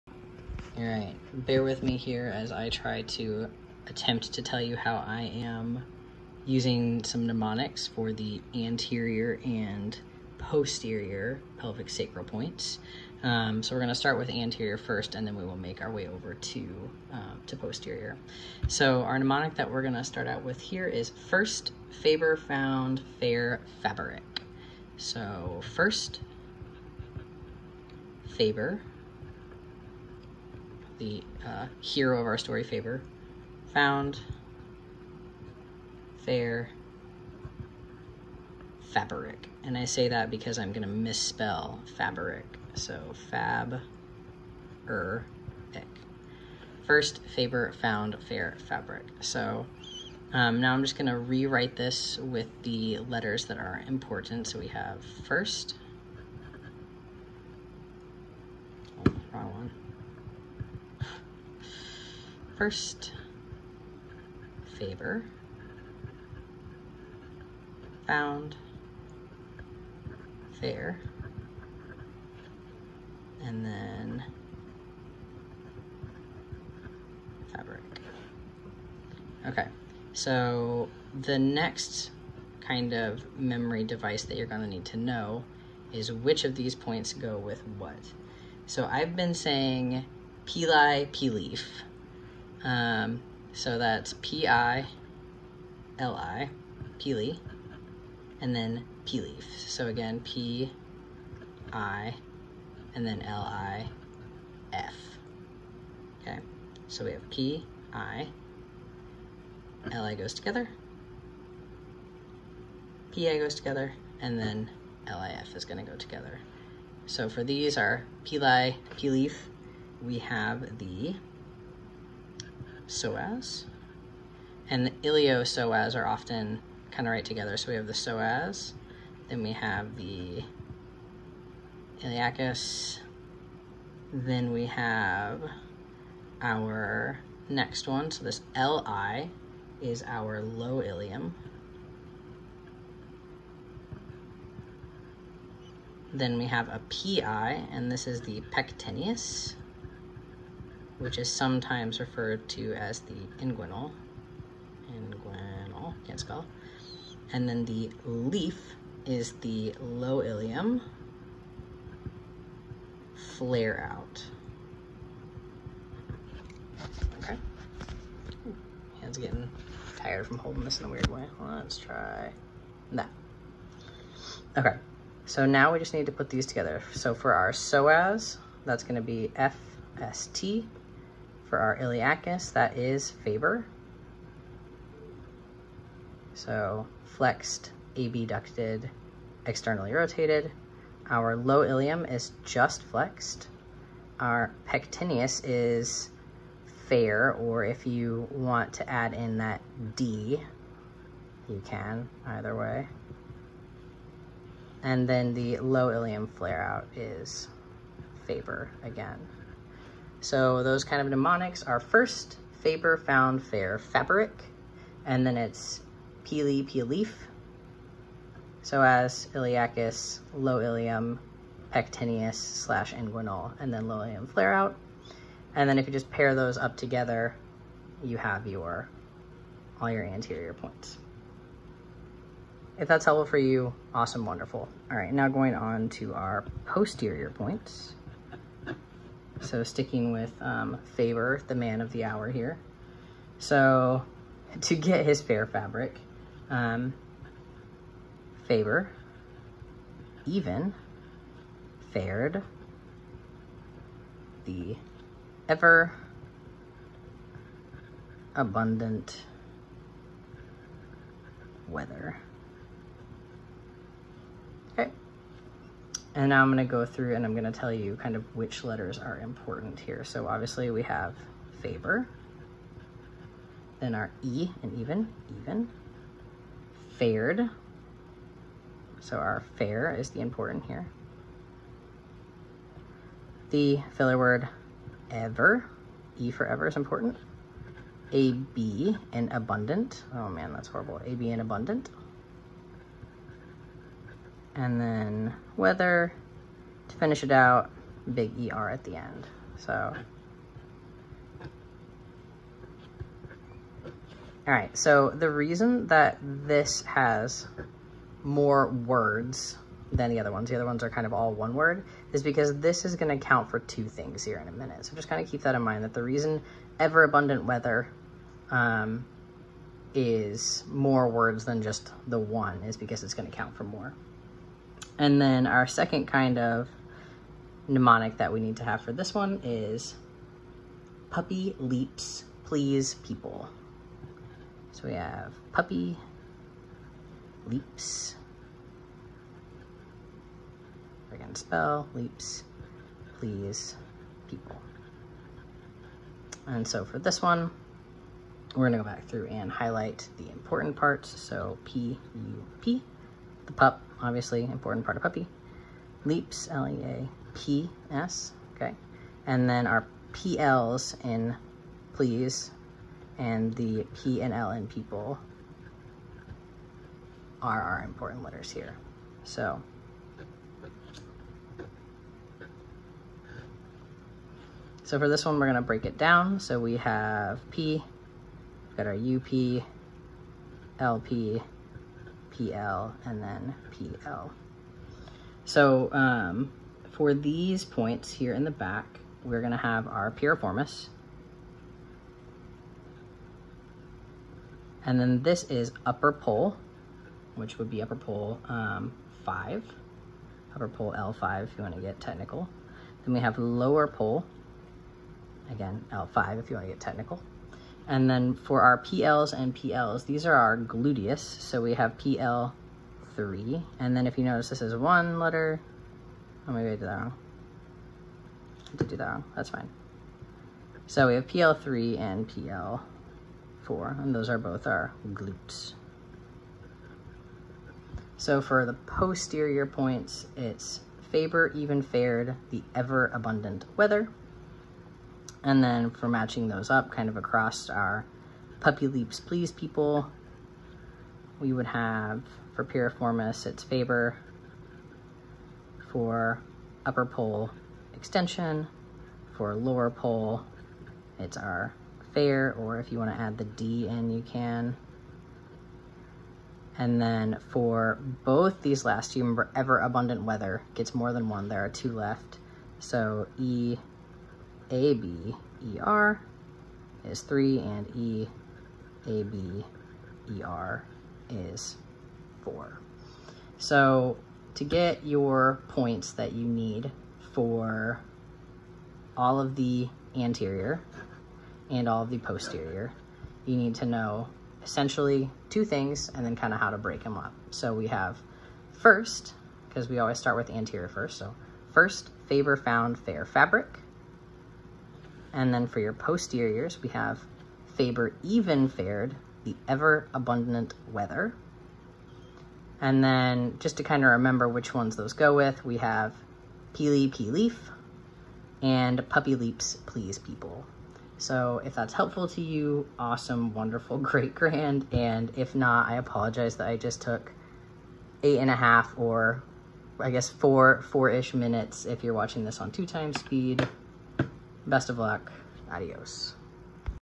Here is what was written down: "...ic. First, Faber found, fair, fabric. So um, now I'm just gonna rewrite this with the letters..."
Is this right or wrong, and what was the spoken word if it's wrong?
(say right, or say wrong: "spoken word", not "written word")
right.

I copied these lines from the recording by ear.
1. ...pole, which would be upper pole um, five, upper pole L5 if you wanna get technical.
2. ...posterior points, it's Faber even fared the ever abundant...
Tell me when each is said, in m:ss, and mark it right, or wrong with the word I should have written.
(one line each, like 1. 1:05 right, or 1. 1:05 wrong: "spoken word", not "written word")
1. 6:36 right
2. 7:08 right.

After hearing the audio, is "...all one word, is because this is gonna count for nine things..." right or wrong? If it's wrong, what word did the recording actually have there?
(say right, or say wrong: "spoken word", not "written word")
wrong: "two", not "nine".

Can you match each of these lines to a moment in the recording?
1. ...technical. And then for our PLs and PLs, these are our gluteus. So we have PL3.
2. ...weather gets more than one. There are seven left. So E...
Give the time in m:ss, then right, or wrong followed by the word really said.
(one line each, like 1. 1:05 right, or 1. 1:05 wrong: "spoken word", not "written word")
1. 6:46 right
2. 7:40 wrong: "two", not "seven".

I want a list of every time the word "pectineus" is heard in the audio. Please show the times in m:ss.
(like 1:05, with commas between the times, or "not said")
2:28, 3:14, 3:41.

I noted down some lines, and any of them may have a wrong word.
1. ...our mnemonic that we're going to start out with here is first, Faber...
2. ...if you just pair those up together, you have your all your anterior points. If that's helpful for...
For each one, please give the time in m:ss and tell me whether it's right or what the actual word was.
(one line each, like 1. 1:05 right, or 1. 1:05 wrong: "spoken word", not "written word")
1. 0:19 right
2. 3:45 right.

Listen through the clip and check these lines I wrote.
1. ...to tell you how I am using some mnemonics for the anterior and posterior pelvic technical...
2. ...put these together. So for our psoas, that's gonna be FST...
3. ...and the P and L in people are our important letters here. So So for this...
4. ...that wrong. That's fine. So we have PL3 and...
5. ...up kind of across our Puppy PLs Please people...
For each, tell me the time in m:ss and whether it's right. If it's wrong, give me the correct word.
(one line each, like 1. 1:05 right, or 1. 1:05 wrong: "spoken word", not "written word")
1. 0:04 wrong: "sacral", not "technical"
2. 2:56 right
3. 6:03 right
4. 6:58 right
5. 7:16 wrong: "Leaps", not "PLs".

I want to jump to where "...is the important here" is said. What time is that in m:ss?
4:39.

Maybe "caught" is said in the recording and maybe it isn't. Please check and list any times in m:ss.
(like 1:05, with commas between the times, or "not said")
not said.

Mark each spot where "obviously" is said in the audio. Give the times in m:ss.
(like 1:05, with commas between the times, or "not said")
4:30, 5:54.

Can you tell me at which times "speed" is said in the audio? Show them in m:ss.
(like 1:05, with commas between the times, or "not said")
8:43.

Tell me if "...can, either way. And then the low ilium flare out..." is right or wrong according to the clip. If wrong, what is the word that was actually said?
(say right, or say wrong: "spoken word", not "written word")
right.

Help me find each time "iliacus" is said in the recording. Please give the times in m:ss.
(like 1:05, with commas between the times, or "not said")
2:12, 3:01, 3:39.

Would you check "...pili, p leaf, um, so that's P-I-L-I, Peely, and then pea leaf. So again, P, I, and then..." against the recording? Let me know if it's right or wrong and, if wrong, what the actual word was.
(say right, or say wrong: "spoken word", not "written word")
right.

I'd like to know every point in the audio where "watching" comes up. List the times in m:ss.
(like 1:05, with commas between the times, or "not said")
8:42.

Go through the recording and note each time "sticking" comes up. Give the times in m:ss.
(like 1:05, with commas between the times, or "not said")
3:59.